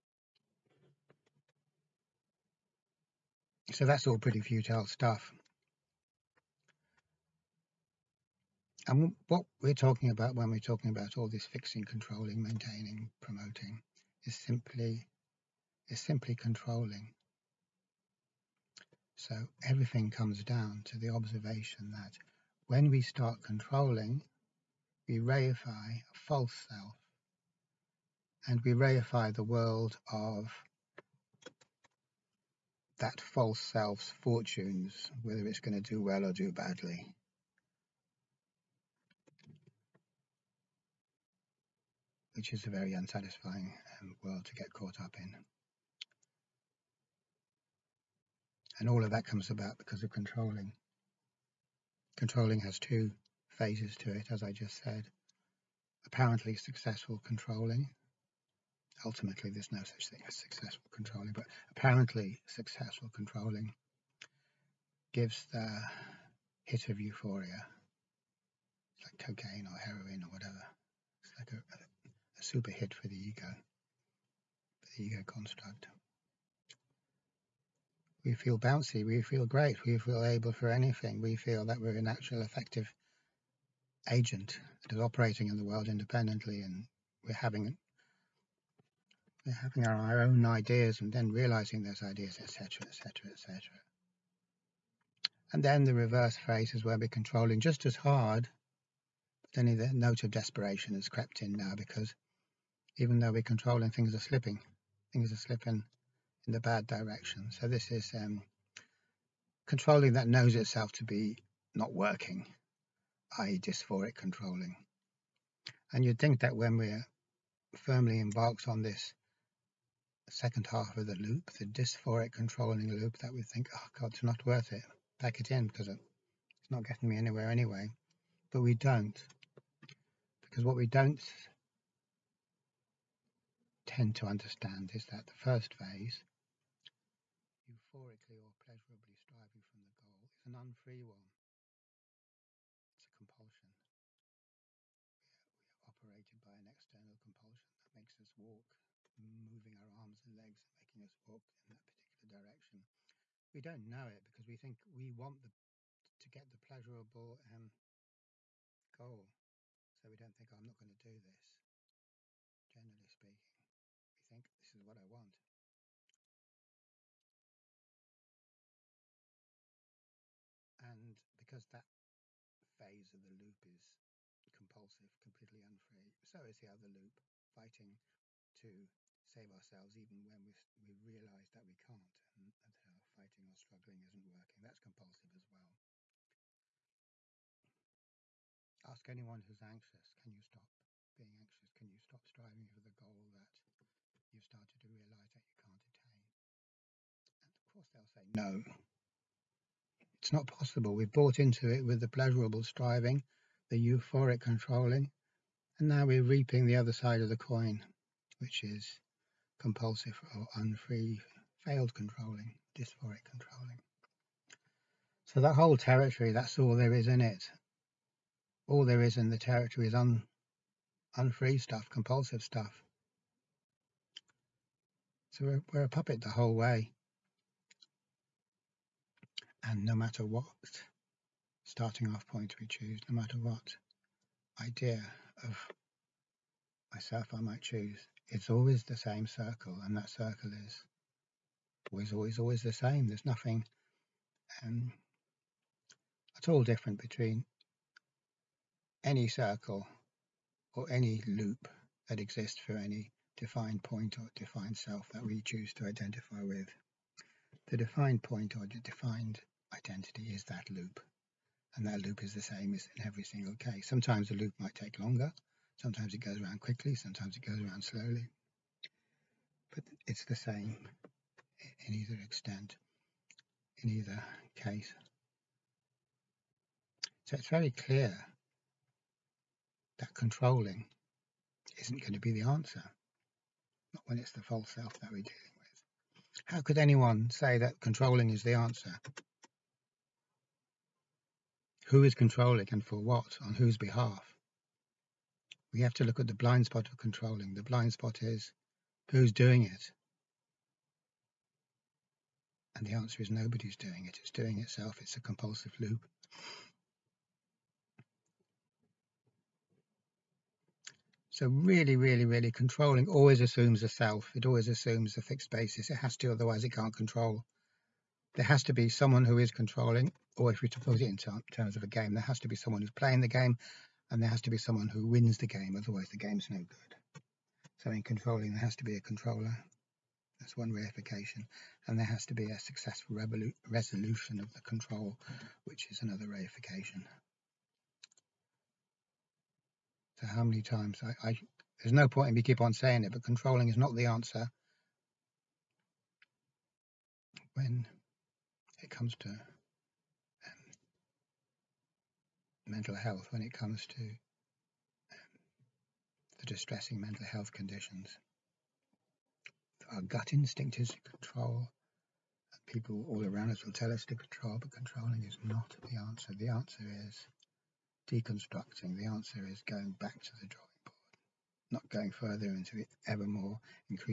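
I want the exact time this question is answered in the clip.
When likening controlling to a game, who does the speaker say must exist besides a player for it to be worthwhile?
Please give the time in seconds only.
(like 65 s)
324 s.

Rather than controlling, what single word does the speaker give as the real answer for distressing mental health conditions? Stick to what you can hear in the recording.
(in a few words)
deconstructing.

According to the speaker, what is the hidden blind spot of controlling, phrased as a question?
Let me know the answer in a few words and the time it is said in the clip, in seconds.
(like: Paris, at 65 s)
who's doing it, at 299 s.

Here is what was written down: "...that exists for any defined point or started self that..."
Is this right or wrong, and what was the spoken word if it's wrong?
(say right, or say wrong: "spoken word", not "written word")
wrong: "defined", not "started".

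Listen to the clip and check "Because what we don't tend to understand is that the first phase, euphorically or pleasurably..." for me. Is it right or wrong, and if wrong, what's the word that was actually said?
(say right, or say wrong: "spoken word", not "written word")
right.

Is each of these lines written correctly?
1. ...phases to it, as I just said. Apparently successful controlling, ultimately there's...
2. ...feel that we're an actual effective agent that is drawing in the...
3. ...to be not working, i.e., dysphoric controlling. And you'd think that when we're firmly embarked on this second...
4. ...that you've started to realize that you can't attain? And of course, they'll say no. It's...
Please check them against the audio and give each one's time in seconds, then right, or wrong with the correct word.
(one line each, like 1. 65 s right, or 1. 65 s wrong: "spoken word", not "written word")
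1. 53 s right
2. 81 s wrong: "operating", not "drawing"
3. 110 s right
4. 193 s right.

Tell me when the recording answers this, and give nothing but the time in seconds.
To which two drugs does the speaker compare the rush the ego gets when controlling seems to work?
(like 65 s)
69 s.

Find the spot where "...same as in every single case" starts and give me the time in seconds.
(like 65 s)
262 s.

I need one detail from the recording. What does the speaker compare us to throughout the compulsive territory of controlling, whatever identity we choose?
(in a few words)
a puppet.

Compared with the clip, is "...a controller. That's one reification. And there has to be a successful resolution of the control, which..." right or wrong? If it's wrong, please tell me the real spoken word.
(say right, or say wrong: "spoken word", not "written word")
right.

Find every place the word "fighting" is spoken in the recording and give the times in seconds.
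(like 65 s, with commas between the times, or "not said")
177 s, 183 s.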